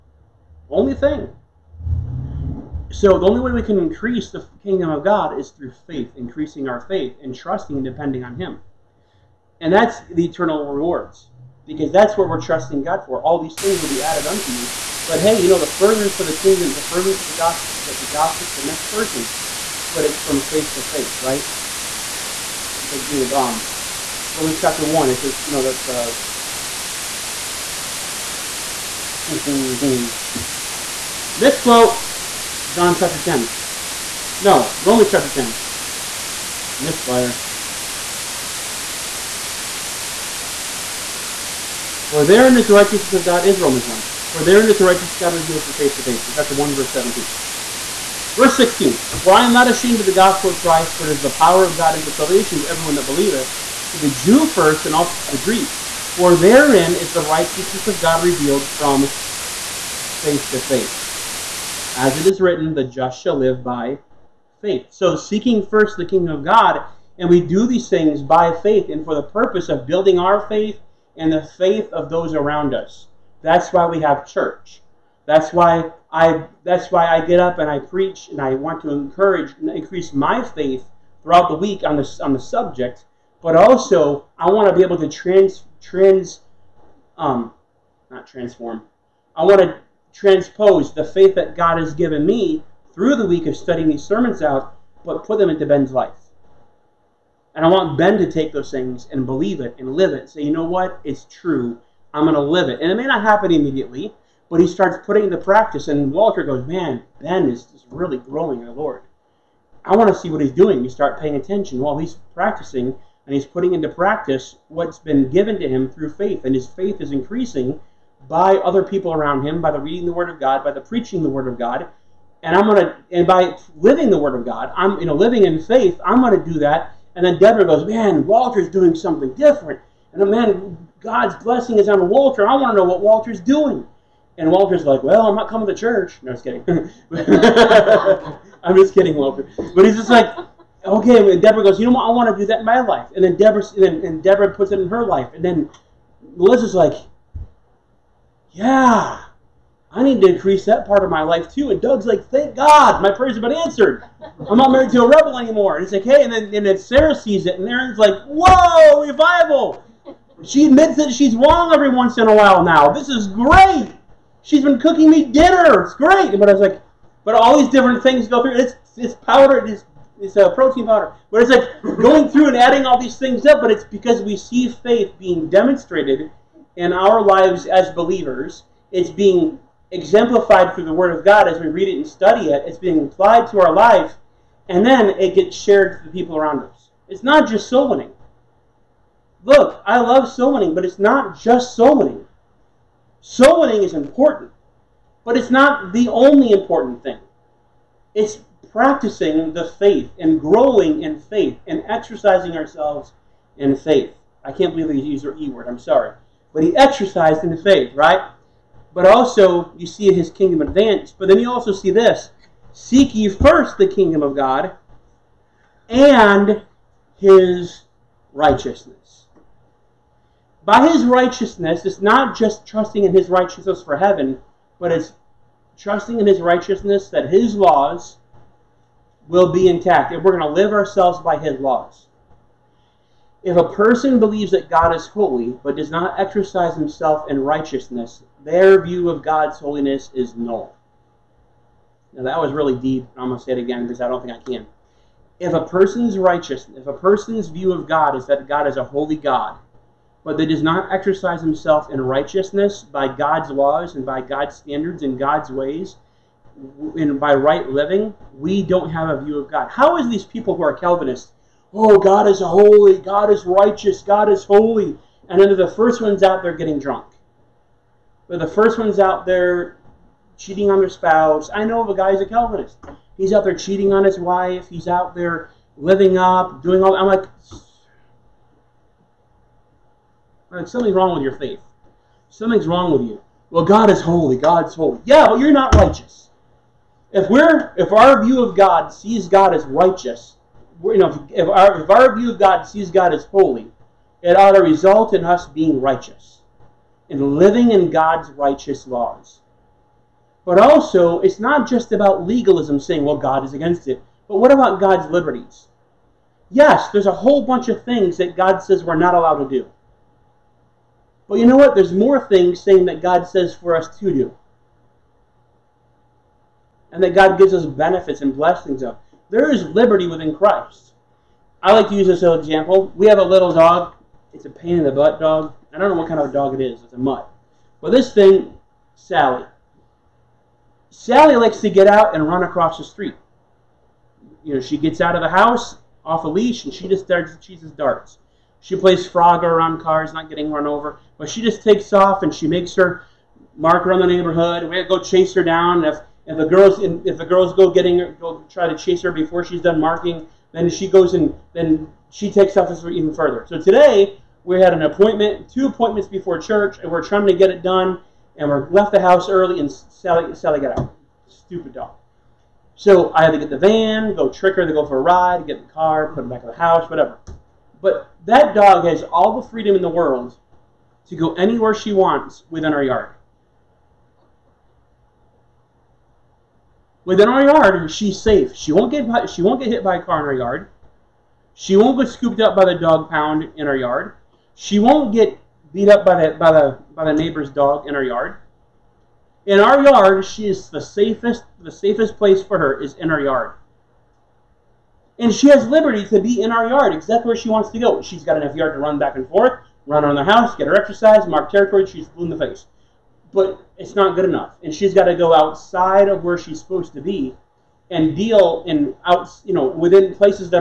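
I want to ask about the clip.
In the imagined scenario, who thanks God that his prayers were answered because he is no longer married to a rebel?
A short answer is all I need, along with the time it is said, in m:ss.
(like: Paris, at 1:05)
Doug, at 2:31.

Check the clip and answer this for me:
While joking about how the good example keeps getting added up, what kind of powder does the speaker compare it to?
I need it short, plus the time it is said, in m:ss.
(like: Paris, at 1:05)
protein powder, at 2:50.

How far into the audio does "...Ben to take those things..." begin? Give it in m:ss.
1:37.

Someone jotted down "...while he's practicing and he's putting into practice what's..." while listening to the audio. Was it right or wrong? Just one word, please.
right.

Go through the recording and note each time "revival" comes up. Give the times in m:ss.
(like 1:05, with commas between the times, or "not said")
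2:39.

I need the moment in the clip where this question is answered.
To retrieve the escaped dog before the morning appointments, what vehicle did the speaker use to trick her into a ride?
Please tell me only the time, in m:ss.
6:03.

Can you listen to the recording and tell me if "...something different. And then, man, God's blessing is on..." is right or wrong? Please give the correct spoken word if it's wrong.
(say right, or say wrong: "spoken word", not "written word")
right.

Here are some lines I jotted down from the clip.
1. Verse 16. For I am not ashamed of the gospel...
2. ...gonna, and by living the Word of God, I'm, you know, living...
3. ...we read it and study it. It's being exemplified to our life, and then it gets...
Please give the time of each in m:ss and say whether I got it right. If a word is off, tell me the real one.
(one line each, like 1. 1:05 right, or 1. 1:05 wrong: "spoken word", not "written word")
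1. 0:48 right
2. 2:02 right
3. 3:01 wrong: "applied", not "exemplified".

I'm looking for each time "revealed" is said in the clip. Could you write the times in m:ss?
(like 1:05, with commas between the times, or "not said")
0:45, 0:58.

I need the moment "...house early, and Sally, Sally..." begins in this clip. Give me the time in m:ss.
5:58.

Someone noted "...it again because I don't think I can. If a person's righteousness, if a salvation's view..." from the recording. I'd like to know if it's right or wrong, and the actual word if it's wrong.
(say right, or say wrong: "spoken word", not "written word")
wrong: "person", not "salvation".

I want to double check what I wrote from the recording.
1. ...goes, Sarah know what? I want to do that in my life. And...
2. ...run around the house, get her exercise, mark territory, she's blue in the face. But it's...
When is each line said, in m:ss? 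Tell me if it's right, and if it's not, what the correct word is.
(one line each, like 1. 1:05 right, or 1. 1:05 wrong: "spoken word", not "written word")
1. 2:21 wrong: "You", not "Sarah"
2. 6:39 right.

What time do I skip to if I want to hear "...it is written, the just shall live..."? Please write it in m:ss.
1:02.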